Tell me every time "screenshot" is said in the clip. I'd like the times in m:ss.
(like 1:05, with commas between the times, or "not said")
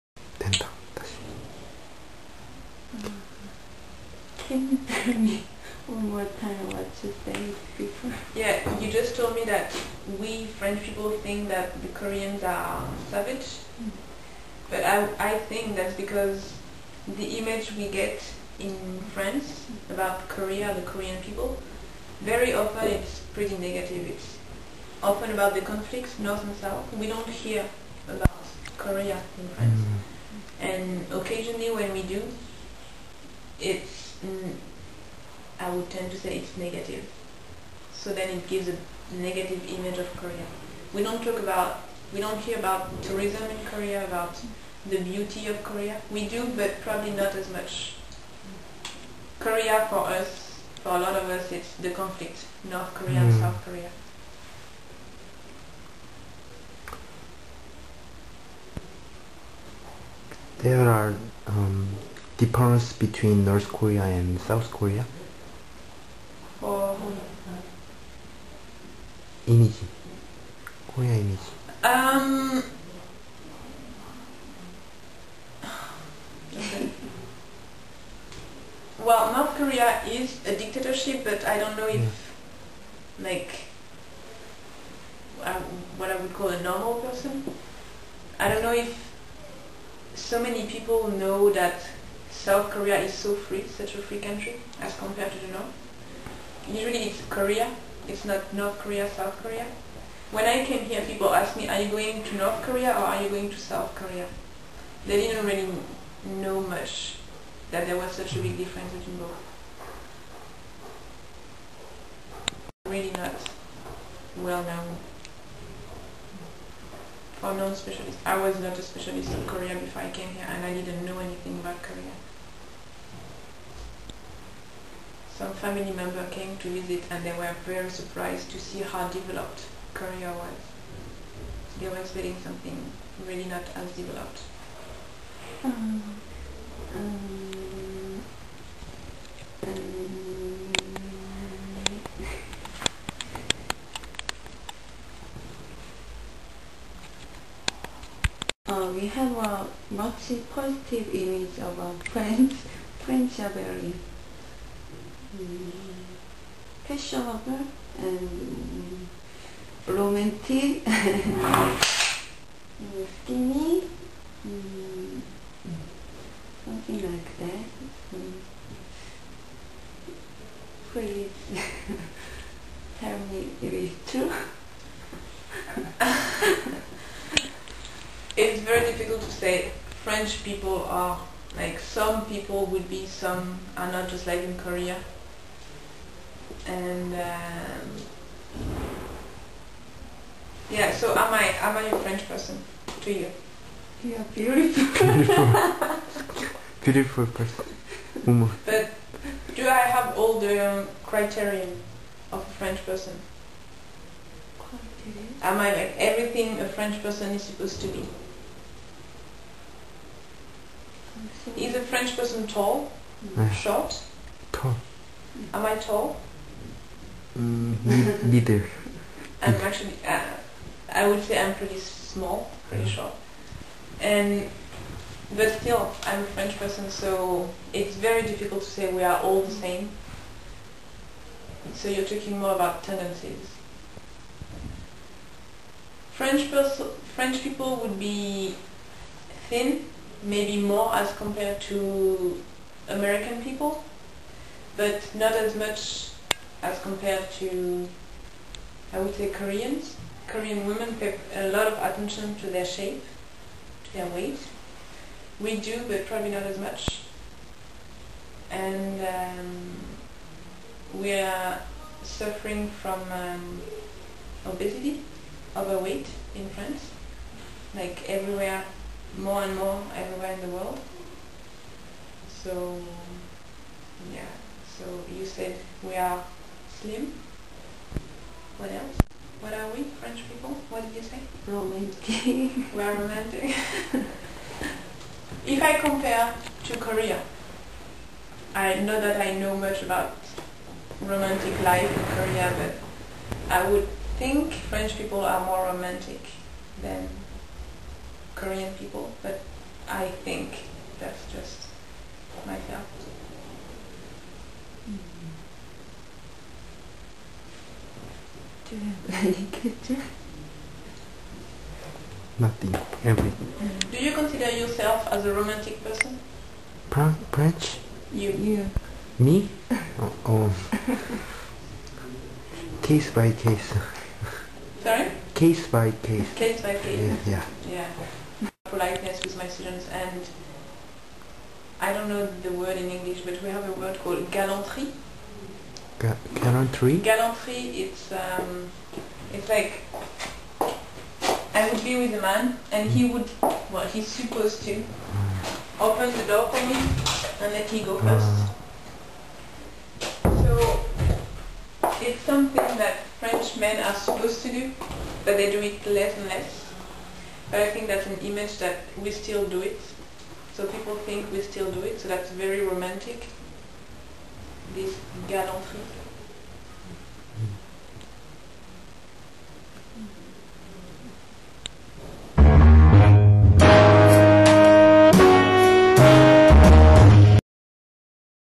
not said.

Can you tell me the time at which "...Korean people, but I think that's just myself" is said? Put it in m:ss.
4:58.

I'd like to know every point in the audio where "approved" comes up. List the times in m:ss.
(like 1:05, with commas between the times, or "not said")
not said.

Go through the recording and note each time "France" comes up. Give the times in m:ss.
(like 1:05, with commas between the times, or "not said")
0:19, 0:29, 4:26.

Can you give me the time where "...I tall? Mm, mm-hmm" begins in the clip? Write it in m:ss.
3:35.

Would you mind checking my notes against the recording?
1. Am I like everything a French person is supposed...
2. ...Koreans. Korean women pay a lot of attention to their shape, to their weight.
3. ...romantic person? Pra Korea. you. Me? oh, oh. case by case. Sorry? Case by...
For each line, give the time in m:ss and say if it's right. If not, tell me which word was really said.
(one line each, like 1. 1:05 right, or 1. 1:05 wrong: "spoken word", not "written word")
1. 3:25 right
2. 4:09 right
3. 5:15 wrong: "You", not "Korea".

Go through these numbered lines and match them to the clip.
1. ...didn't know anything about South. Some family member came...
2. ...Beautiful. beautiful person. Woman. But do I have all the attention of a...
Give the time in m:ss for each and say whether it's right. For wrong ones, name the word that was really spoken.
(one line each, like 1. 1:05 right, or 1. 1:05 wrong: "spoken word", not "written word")
1. 2:00 wrong: "Korea", not "South"
2. 3:15 wrong: "criterion", not "attention".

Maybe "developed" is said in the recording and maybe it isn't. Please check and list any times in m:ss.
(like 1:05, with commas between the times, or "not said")
2:09, 2:13.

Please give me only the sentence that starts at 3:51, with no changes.
So you're talking more about tendencies.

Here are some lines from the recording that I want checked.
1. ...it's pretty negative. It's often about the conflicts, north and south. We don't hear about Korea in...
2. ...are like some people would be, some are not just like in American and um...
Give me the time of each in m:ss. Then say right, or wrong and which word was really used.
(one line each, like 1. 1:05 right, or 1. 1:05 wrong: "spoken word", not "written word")
1. 0:22 right
2. 3:00 wrong: "Korea", not "American".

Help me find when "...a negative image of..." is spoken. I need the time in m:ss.
0:38.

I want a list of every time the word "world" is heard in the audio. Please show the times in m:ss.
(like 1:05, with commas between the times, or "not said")
4:30.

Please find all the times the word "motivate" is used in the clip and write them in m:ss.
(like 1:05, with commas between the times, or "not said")
not said.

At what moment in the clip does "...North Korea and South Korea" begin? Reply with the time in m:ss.
1:03.